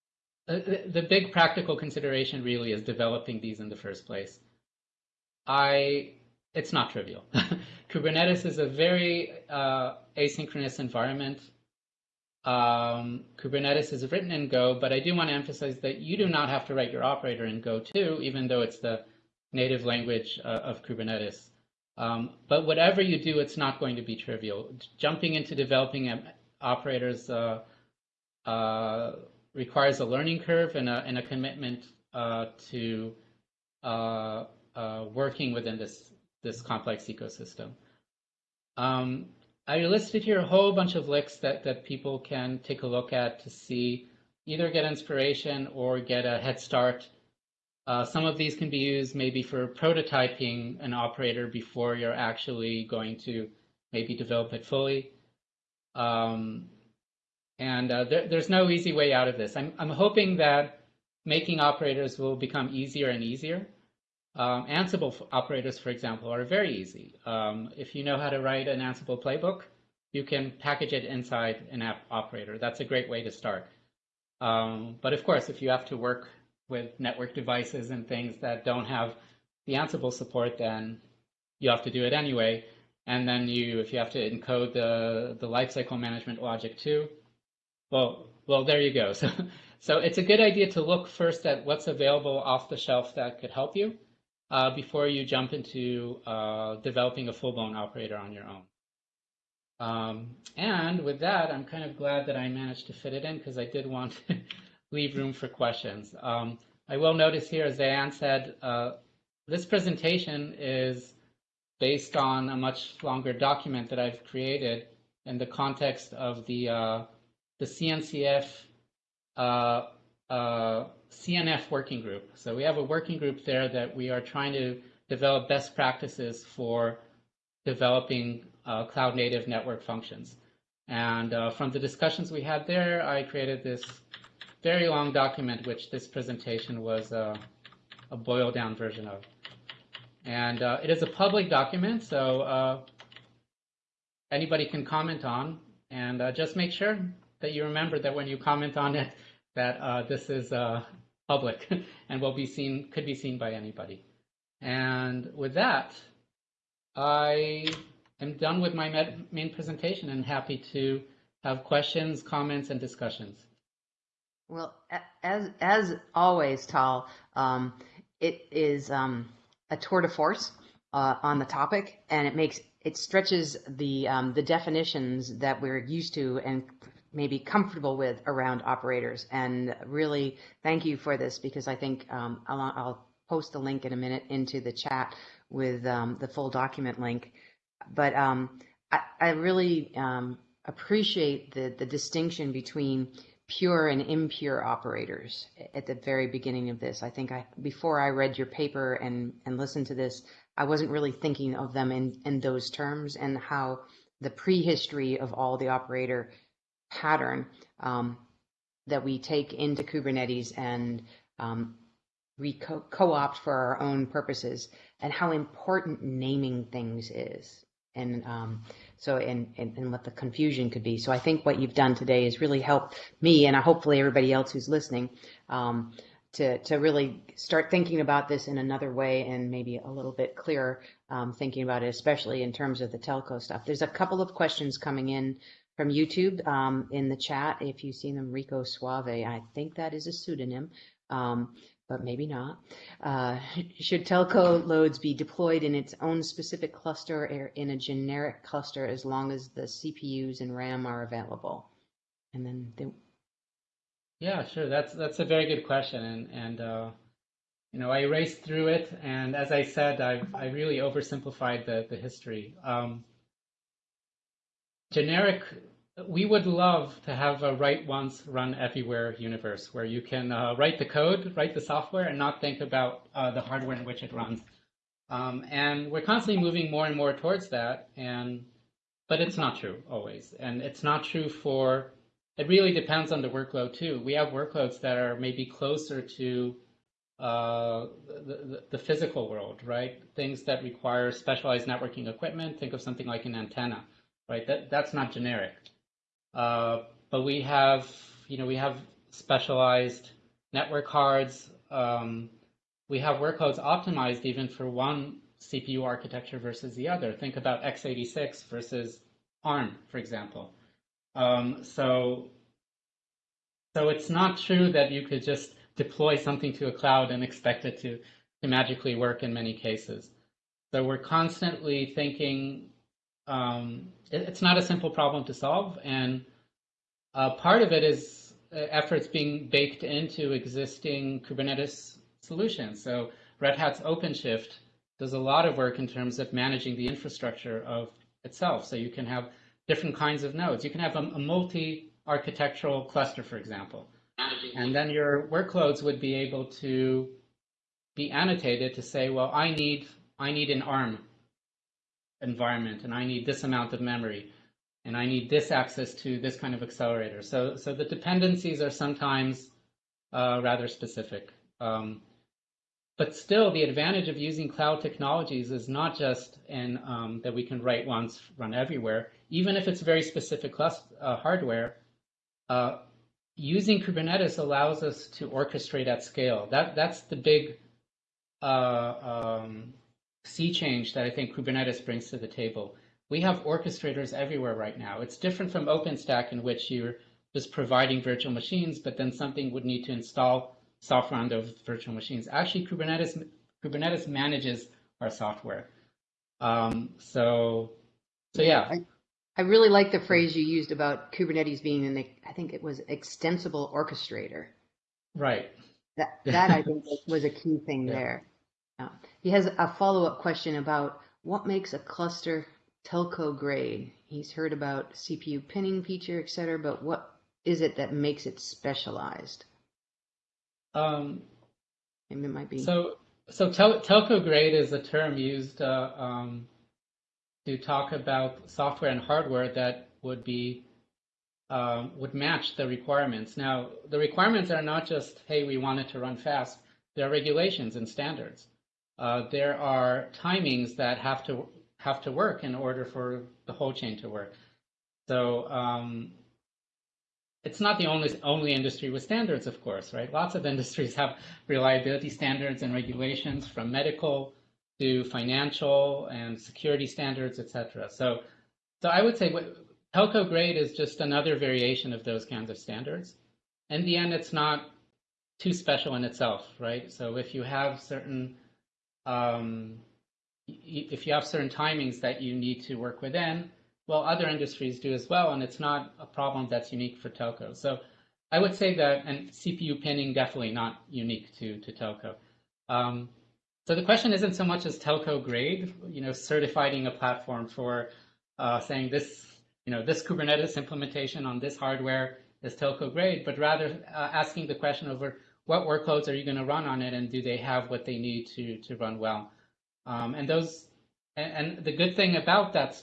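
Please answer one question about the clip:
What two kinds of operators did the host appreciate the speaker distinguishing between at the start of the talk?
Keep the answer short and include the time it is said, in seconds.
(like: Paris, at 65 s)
pure and impure, at 193 s.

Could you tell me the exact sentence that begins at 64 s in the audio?
Um, Ansible operators, for example, are very easy.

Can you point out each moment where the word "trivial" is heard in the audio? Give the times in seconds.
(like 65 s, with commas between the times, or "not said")
6 s, 24 s.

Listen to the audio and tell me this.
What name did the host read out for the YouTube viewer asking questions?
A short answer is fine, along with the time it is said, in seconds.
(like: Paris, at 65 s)
Rico Suave, at 238 s.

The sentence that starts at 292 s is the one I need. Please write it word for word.
Think of something like an antenna, right?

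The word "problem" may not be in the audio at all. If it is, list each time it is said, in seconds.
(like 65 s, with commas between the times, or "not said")
324 s, 476 s.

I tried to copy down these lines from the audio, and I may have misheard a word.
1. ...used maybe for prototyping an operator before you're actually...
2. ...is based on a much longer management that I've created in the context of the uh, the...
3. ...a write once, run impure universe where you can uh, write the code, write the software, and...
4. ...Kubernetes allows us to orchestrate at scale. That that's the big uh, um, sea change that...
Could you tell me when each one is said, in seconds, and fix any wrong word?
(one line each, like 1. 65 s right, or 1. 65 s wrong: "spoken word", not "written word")
1. 48 s right
2. 110 s wrong: "document", not "management"
3. 267 s wrong: "everywhere", not "impure"
4. 373 s right.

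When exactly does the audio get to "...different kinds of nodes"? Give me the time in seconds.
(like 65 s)
339 s.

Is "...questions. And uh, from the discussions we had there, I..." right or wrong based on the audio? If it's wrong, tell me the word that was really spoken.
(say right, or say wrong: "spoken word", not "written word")
wrong: "functions", not "questions".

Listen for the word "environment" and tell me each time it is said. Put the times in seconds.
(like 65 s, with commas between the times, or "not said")
10 s, 352 s.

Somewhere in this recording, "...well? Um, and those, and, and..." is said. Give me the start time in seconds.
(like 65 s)
498 s.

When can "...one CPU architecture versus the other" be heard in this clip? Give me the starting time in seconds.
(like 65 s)
304 s.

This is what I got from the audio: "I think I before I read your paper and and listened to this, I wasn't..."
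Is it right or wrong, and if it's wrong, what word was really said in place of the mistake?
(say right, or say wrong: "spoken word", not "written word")
right.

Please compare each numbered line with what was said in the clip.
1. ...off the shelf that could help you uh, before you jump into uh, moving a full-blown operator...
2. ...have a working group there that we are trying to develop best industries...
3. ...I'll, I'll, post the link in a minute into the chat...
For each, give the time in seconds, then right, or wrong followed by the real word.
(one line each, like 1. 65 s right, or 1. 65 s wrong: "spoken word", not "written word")
1. 92 s wrong: "developing", not "moving"
2. 122 s wrong: "practices", not "industries"
3. 182 s right.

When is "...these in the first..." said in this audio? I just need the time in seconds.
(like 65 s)
3 s.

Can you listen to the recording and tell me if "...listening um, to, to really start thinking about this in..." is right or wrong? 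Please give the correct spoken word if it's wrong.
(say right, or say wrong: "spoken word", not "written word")
right.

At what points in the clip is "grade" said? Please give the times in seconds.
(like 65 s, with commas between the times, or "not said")
413 s, 424 s, 460 s, 485 s, 492 s.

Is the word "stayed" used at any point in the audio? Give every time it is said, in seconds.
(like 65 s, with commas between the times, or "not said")
not said.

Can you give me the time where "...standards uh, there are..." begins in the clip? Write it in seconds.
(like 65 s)
437 s.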